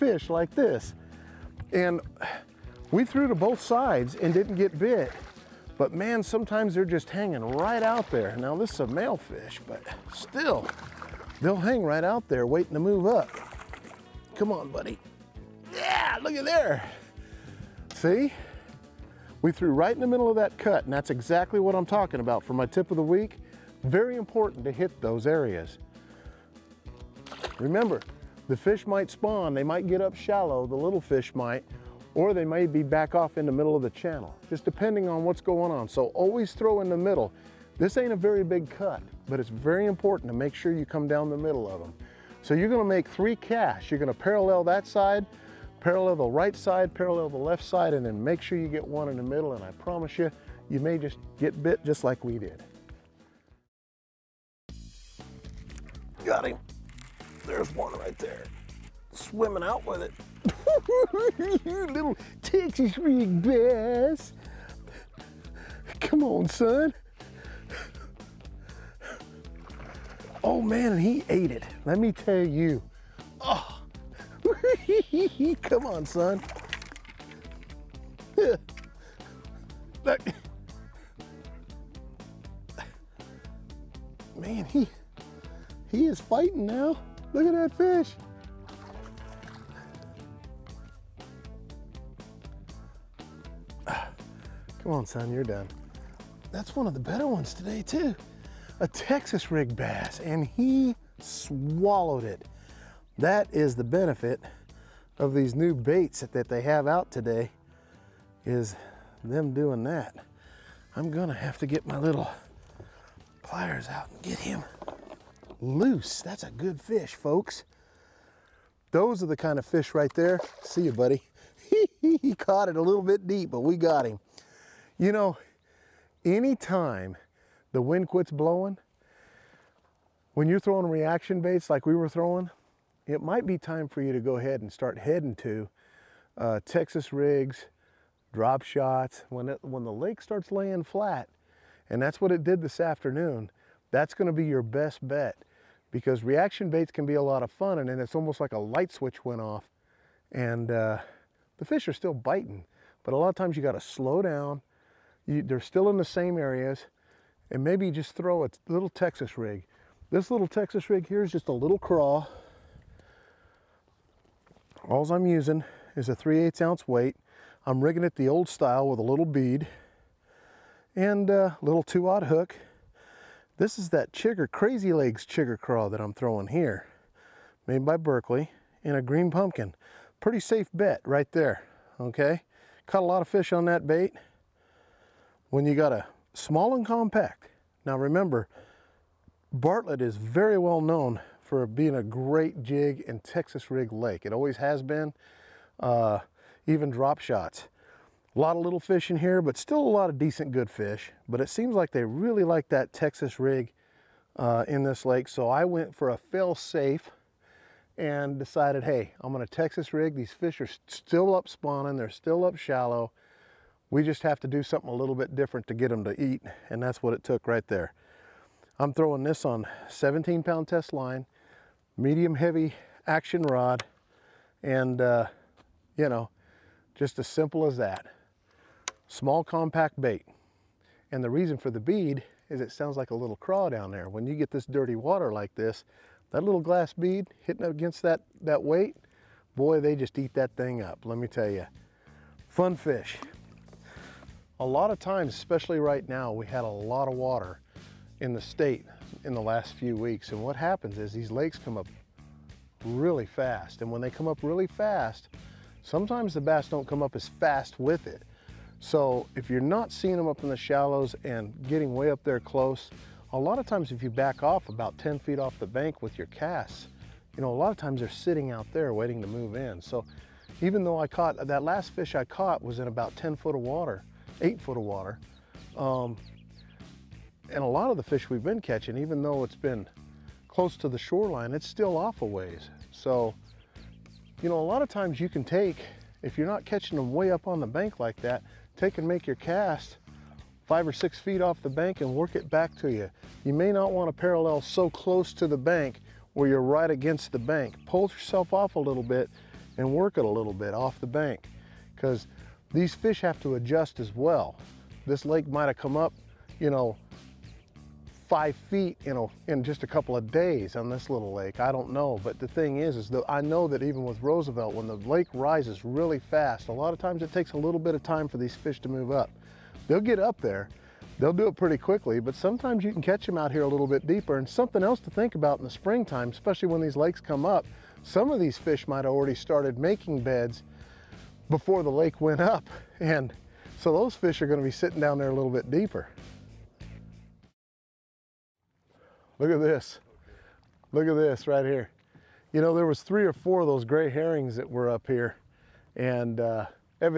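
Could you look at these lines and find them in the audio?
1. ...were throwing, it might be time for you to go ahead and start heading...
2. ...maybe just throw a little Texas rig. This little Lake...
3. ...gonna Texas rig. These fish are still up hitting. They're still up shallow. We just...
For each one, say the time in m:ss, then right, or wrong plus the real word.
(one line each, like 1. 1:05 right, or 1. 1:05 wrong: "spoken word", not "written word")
1. 2:11 right
2. 2:37 wrong: "Texas", not "Lake"
3. 3:29 wrong: "spawning", not "hitting".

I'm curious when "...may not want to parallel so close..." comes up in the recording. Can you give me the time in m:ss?
4:53.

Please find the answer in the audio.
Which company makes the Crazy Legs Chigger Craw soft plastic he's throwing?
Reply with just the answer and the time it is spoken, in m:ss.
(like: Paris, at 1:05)
Berkley, at 2:57.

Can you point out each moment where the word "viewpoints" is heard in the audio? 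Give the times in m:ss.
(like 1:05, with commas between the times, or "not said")
not said.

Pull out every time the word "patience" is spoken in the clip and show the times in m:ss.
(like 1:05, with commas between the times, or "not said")
not said.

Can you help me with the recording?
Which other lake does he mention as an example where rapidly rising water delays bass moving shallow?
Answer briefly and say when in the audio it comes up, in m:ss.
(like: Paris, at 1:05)
Roosevelt, at 5:14.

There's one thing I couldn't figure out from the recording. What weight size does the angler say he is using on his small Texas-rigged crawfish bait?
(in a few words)
3/8 ounce.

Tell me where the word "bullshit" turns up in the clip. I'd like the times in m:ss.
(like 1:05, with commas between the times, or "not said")
not said.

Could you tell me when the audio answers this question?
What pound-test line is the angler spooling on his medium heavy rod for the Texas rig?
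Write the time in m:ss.
3:39.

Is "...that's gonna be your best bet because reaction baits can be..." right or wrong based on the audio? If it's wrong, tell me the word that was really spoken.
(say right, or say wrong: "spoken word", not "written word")
right.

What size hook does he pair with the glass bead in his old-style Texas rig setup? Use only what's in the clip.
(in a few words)
2/0.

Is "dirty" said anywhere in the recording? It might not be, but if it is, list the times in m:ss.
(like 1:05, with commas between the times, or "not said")
3:54.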